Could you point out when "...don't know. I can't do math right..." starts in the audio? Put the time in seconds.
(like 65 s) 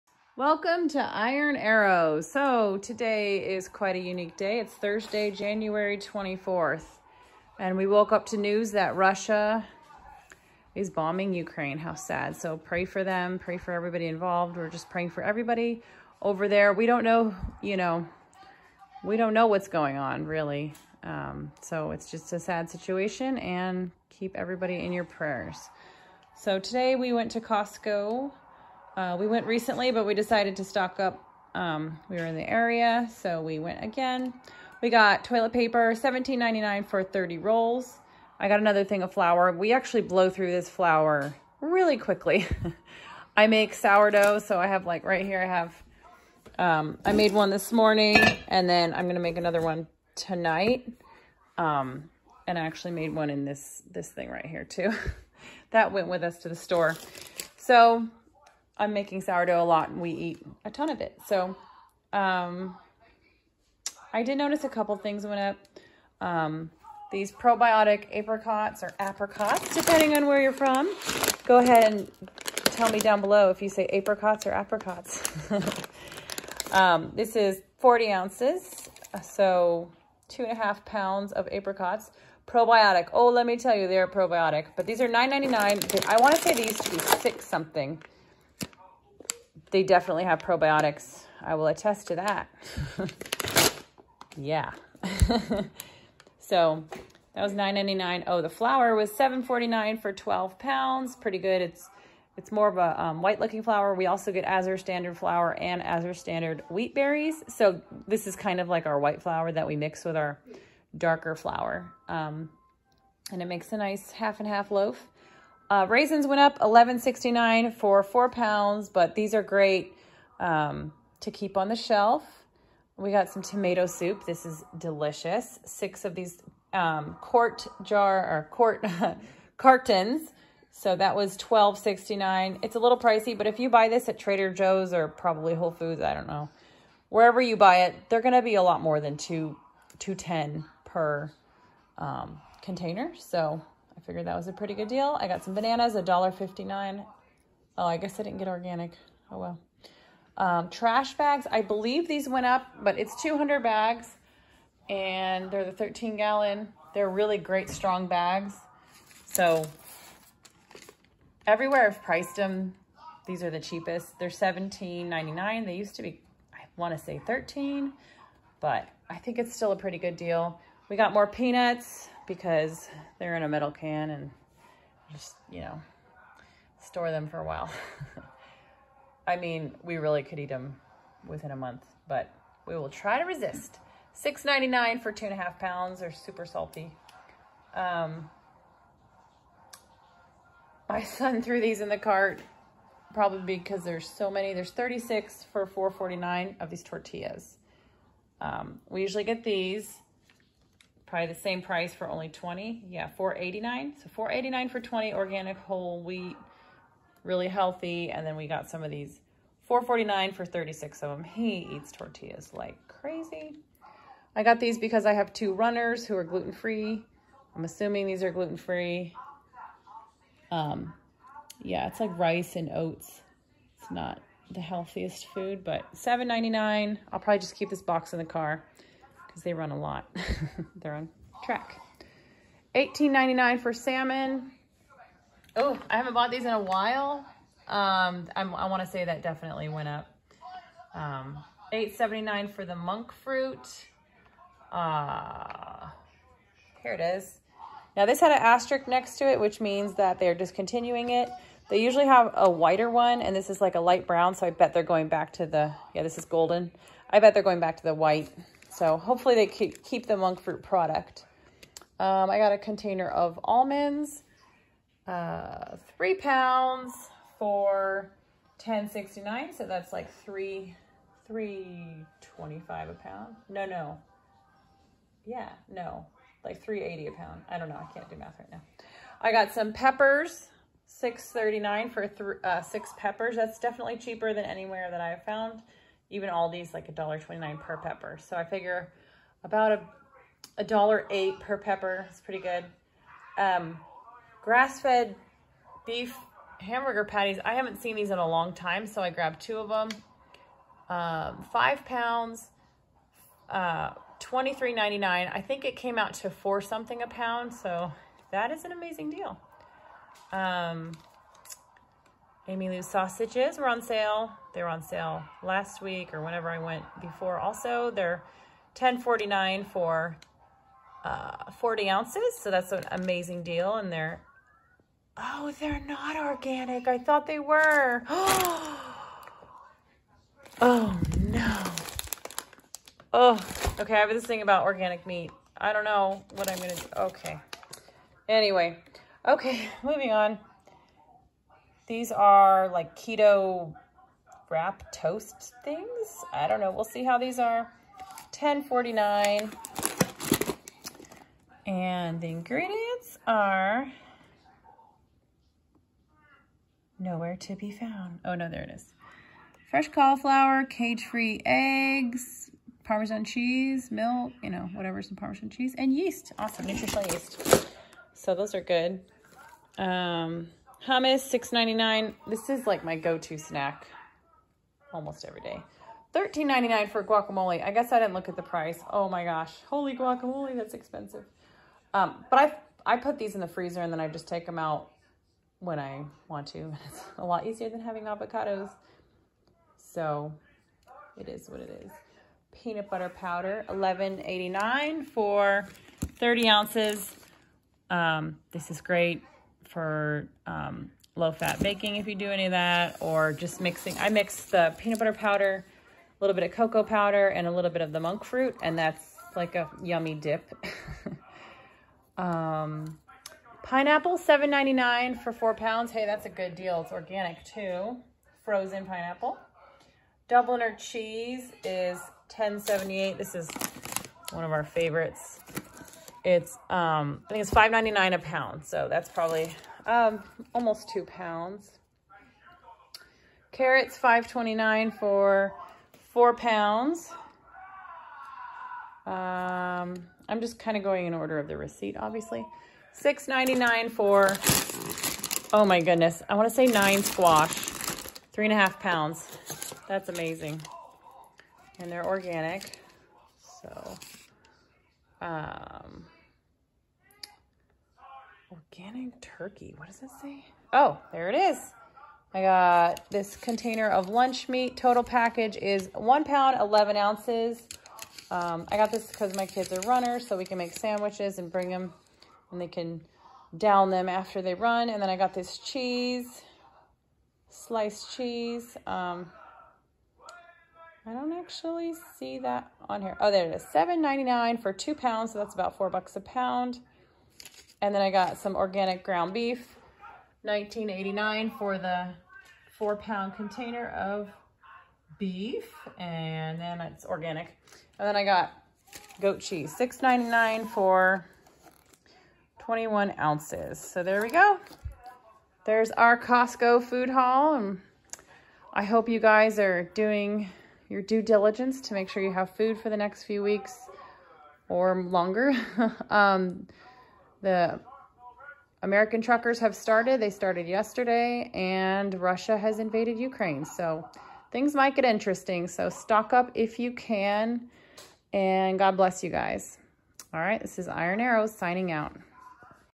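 277 s.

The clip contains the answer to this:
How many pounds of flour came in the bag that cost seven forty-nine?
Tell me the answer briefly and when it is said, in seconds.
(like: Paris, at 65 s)
12, at 100 s.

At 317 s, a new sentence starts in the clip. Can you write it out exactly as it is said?
Also, they're 10.49 for uh, 40 ounces.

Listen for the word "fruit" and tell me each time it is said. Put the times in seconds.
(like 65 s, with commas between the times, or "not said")
243 s, 260 s, 408 s.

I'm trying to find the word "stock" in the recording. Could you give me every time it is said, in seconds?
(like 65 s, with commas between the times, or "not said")
30 s, 525 s.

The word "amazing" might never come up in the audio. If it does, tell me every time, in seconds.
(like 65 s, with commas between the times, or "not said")
308 s, 322 s, 450 s.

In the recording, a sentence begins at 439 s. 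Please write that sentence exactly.
Um, I'm just kind of going in order of the receipt, obviously.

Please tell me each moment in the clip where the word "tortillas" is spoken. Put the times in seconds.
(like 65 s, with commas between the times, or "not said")
196 s, 211 s.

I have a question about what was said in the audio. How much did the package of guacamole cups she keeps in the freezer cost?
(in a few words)
$13.99.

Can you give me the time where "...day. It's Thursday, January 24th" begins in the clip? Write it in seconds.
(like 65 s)
4 s.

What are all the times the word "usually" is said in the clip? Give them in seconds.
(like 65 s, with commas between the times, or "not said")
199 s, 251 s.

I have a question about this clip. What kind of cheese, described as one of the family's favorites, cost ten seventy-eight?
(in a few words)
Dubliner.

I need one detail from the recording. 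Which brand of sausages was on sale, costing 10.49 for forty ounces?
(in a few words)
Amylu's.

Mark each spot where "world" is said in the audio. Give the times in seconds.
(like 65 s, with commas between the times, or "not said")
not said.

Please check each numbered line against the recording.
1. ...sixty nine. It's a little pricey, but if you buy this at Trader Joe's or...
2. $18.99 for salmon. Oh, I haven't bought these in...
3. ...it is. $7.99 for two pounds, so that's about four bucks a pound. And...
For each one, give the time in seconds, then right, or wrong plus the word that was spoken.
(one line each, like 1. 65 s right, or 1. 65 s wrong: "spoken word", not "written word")
1. 131 s right
2. 232 s right
3. 483 s right.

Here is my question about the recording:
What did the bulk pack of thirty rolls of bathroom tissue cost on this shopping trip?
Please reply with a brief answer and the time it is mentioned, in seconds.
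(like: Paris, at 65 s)
$17.99, at 35 s.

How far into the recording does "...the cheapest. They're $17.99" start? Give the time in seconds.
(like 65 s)
163 s.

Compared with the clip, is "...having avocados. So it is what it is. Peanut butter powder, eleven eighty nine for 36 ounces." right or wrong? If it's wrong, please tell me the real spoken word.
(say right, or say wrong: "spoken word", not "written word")
wrong: "30", not "36".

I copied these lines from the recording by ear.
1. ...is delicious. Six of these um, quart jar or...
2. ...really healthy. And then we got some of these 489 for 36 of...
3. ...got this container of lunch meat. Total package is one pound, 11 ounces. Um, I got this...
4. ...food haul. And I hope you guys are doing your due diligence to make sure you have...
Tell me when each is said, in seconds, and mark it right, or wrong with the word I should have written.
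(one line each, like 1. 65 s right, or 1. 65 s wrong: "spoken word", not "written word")
1. 124 s right
2. 207 s wrong: "449", not "489"
3. 462 s right
4. 506 s right.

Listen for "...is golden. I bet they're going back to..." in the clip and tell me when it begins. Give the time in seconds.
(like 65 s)
256 s.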